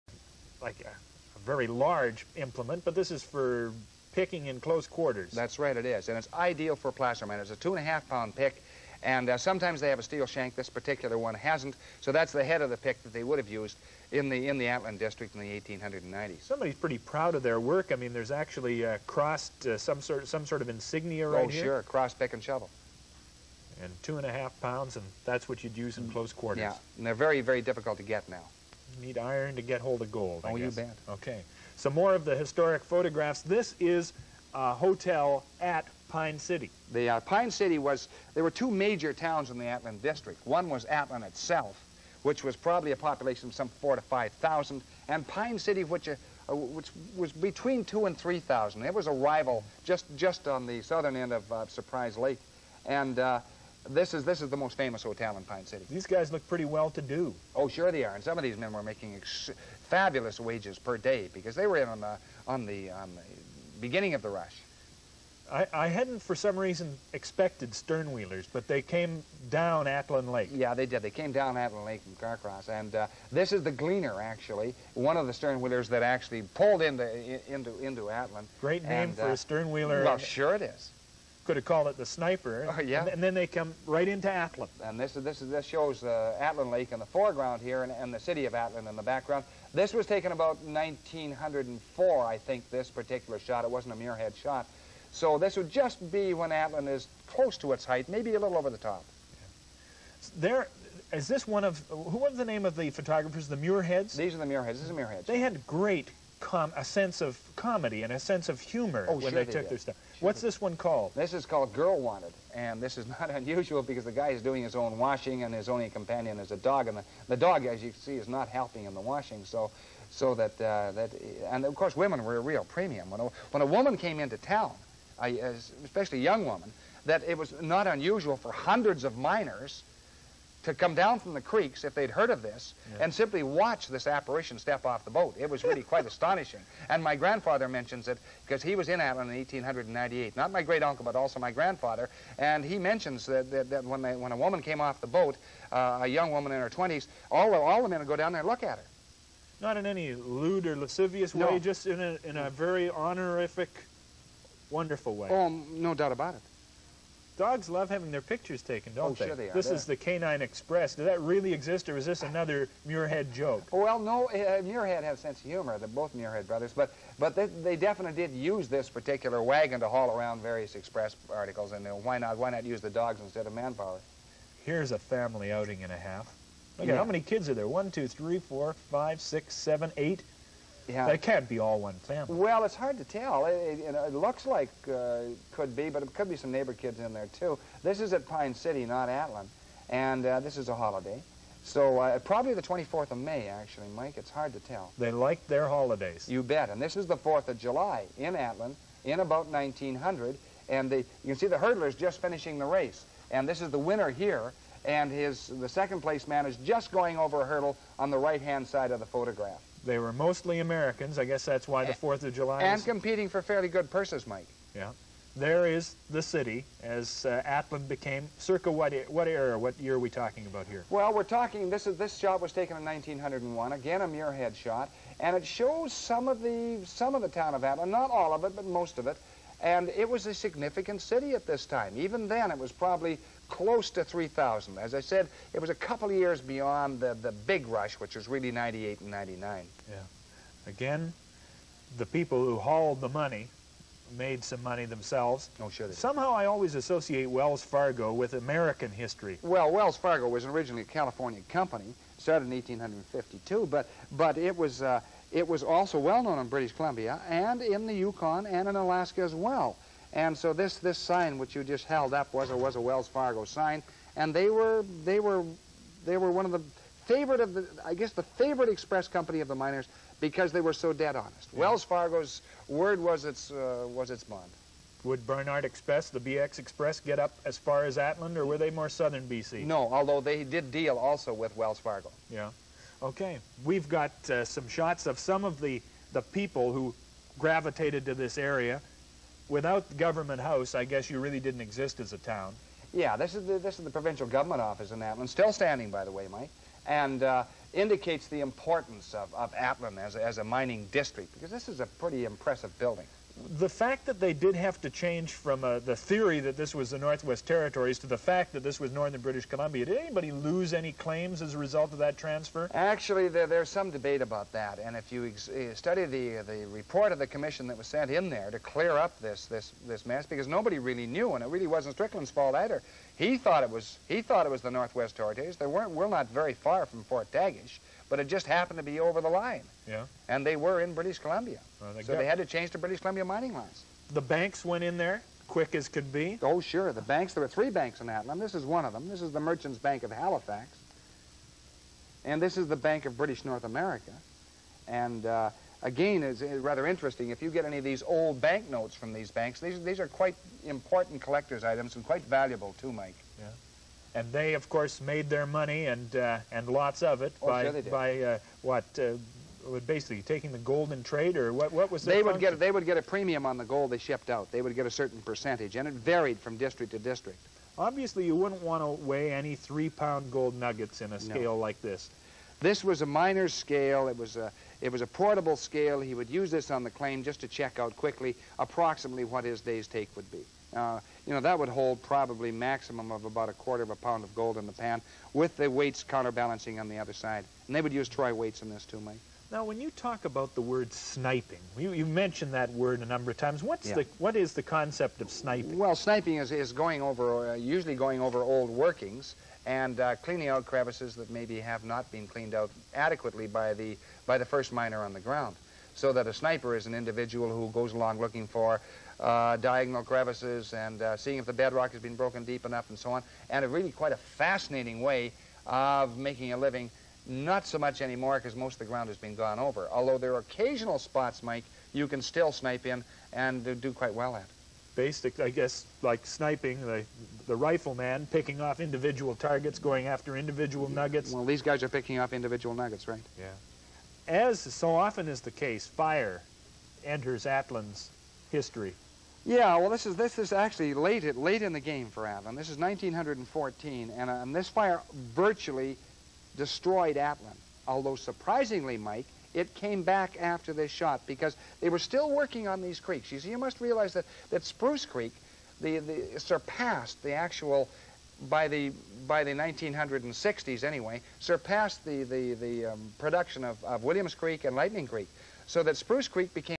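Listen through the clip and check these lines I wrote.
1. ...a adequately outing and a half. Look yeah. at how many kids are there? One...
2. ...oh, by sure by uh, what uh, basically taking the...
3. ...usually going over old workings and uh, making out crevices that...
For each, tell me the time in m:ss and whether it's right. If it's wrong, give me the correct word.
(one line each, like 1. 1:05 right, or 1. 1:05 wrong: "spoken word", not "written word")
1. 2:54 wrong: "family", not "adequately"
2. 5:57 right
3. 6:37 wrong: "cleaning", not "making".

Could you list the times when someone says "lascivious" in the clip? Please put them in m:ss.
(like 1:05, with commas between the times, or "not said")
2:30.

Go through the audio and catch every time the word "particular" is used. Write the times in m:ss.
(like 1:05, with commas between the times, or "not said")
0:10, 1:32, 2:48.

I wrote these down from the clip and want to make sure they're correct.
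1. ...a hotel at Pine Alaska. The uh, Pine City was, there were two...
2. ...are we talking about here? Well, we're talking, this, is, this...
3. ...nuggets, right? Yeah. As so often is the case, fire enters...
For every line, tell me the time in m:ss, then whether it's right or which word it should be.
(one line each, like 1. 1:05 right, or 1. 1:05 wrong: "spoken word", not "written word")
1. 0:34 wrong: "City", not "Alaska"
2. 3:39 right
3. 7:12 right.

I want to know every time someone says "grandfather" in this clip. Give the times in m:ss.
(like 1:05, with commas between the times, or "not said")
2:17, 2:21.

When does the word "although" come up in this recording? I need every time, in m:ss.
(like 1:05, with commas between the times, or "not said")
4:39, 6:59, 7:27.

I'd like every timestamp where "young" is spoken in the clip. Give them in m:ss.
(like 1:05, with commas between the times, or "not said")
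2:06, 2:26.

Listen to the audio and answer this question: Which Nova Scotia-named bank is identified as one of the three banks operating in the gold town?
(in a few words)
Merchants Bank of Halifax.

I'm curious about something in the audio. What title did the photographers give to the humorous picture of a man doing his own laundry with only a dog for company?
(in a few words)
Girl Wanted.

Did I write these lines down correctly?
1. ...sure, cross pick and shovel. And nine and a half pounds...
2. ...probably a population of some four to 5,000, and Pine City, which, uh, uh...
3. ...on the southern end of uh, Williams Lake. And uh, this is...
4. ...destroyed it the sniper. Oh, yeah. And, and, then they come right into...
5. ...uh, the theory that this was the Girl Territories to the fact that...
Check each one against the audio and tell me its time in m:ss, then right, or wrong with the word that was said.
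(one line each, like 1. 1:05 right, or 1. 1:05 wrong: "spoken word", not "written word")
1. 0:21 wrong: "two", not "nine"
2. 0:42 right
3. 0:50 wrong: "Surprise", not "Williams"
4. 1:21 wrong: "called", not "destroyed"
5. 5:05 wrong: "Northwest", not "Girl".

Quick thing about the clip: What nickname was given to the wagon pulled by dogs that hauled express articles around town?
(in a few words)
Canine Express.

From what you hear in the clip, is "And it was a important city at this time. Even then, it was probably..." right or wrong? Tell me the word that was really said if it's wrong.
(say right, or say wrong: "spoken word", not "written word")
wrong: "significant", not "important".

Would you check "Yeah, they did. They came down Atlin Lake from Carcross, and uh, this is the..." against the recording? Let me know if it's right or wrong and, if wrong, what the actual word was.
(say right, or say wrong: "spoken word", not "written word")
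right.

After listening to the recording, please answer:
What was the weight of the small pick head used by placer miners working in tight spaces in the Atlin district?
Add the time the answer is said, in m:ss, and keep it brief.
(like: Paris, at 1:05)
2.5 pounds, at 0:07.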